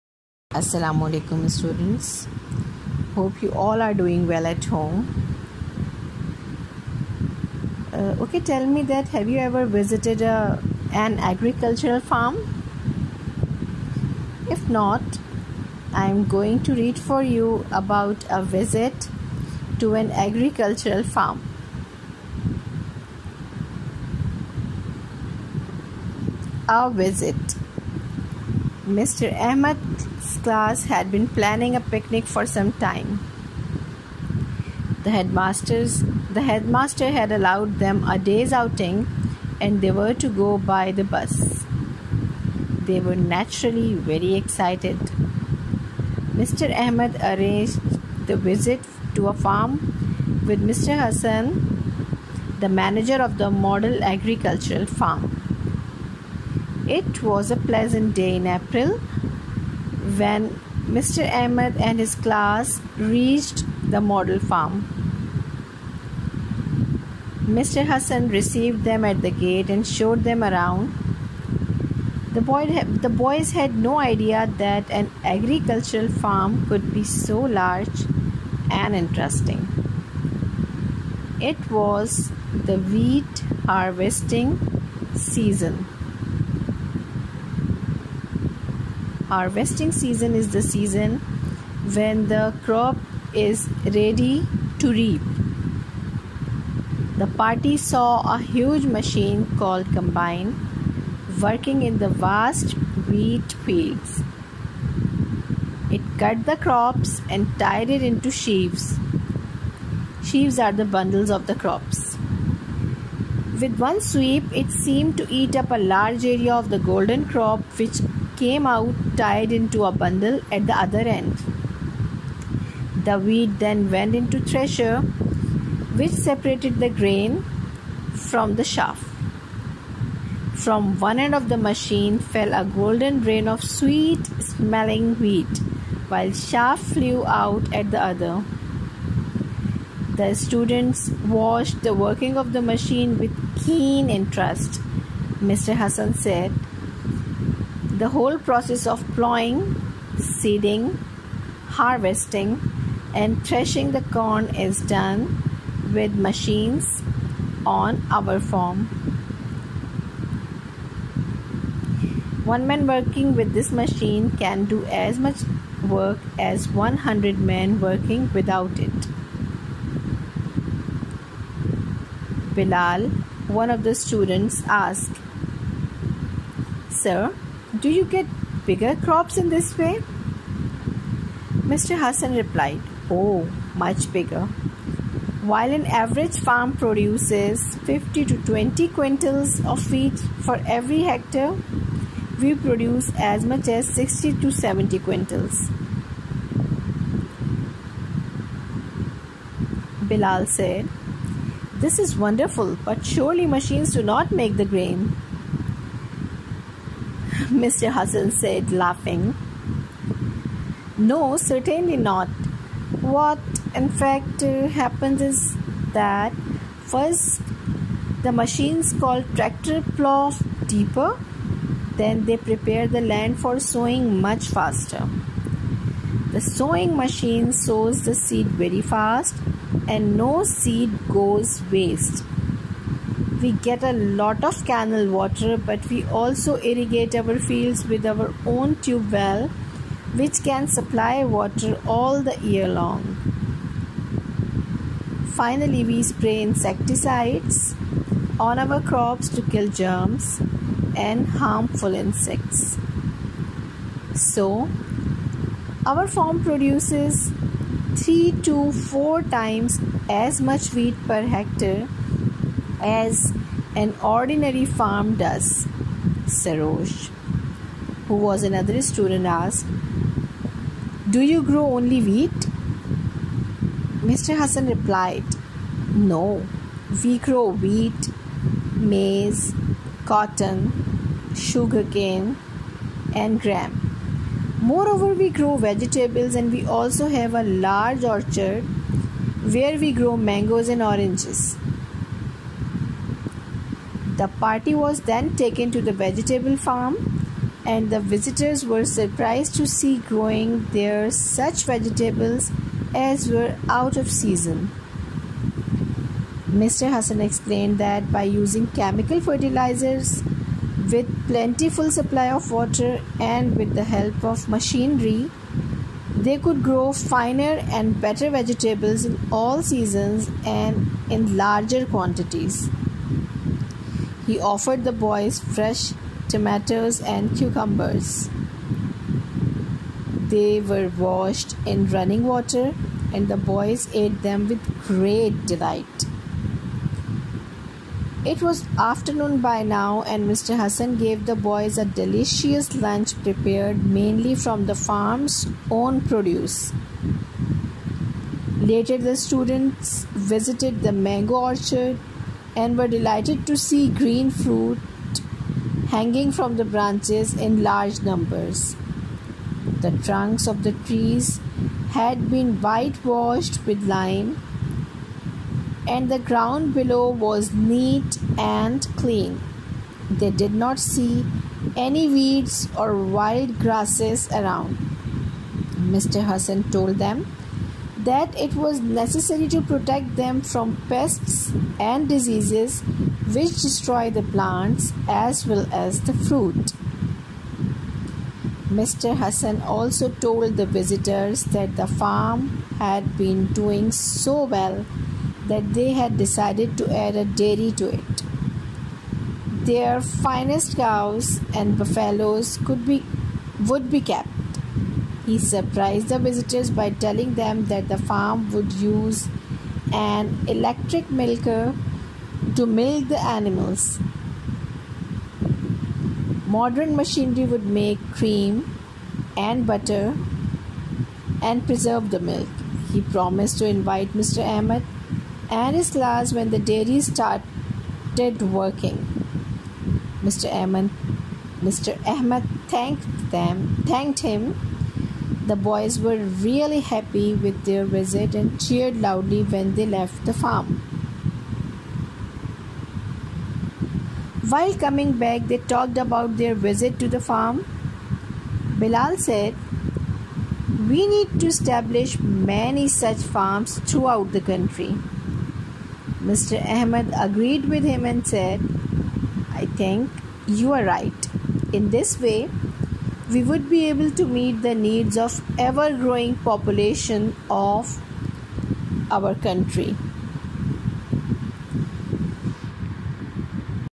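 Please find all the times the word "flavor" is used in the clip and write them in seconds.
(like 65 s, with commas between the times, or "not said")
not said.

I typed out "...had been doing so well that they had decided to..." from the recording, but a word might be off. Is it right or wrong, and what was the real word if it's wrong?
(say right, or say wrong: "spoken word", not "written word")
right.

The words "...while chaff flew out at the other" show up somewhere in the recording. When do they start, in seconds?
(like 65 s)
136 s.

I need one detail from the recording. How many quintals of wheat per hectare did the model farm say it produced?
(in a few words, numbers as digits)
60 to 70.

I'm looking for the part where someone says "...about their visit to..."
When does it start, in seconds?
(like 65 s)
445 s.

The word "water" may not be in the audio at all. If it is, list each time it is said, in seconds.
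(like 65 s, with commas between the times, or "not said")
235 s, 241 s, 312 s, 332 s.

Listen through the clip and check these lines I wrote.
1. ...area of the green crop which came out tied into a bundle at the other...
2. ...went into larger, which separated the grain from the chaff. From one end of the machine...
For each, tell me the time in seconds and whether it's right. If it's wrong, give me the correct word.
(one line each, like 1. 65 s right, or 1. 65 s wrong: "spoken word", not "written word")
1. 116 s wrong: "golden", not "green"
2. 123 s wrong: "thresher", not "larger".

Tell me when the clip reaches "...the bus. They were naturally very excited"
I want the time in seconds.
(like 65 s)
40 s.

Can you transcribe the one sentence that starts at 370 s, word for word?
They did not see any weeds or wild grasses around.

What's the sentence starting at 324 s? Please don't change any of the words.
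He offered the boys fresh tomatoes and cucumbers.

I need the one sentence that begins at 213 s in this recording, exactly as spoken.
What in fact happens is that first the machines called tractor plow deeper, then they prepare the land for sowing much faster.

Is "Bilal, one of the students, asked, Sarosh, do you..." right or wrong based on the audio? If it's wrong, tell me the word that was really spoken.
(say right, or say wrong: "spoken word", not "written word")
wrong: "Sir", not "Sarosh".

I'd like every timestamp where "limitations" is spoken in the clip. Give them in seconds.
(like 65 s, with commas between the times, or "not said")
not said.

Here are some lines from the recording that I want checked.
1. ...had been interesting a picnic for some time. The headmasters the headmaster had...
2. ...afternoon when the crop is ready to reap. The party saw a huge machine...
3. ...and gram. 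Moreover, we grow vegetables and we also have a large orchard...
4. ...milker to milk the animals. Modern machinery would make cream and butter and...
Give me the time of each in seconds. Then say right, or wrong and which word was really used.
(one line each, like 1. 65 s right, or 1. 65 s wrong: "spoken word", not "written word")
1. 30 s wrong: "planning", not "interesting"
2. 90 s wrong: "season", not "afternoon"
3. 283 s right
4. 411 s right.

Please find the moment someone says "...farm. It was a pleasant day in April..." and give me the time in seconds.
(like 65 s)
54 s.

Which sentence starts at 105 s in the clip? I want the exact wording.
It cut the crops and tied it into sheaves.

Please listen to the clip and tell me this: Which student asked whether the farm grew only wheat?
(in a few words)
Sarosh.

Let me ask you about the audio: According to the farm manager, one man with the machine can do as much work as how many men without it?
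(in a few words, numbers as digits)
100.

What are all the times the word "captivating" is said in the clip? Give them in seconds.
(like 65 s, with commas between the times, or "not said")
not said.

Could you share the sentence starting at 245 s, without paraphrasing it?
Finally, we spray insecticides on our crops to kill germs and harmful insects.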